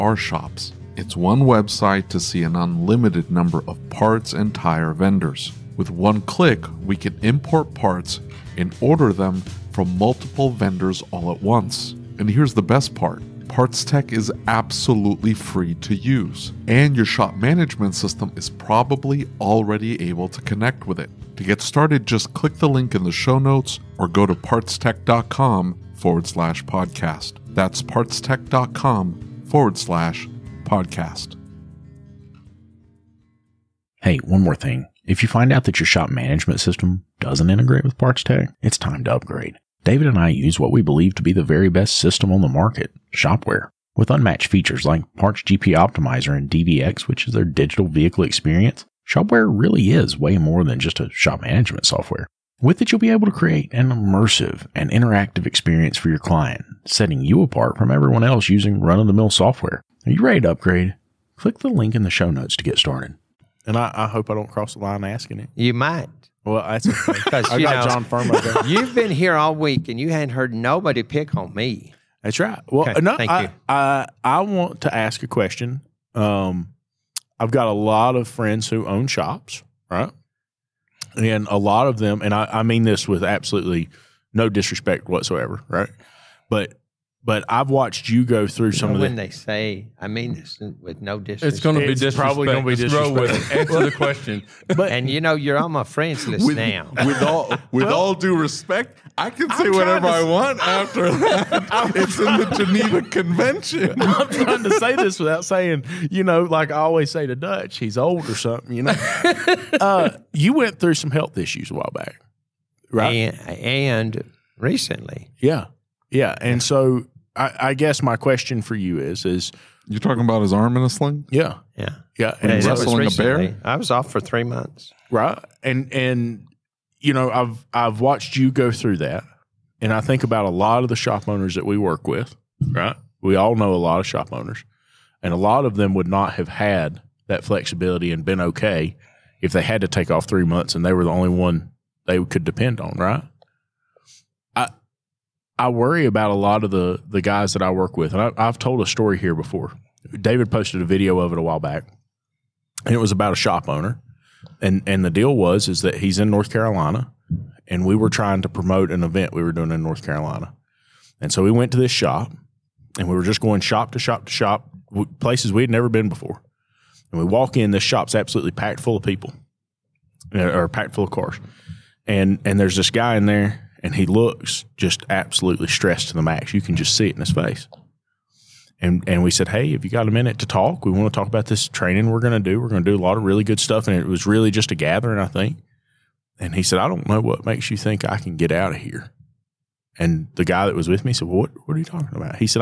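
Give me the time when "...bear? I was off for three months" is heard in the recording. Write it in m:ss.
2:03.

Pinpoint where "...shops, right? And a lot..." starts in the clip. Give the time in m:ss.
1:19.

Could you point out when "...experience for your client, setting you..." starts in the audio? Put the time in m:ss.
0:55.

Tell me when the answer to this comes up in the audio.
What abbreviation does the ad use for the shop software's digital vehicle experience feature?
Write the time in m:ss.
0:46.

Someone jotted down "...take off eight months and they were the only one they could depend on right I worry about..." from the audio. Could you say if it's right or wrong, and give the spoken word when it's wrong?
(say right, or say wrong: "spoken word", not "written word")
wrong: "three", not "eight".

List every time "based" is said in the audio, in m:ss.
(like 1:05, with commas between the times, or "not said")
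not said.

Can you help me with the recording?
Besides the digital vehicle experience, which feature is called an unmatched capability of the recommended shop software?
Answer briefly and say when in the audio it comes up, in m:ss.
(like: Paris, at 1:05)
Parts GP Optimizer, at 0:45.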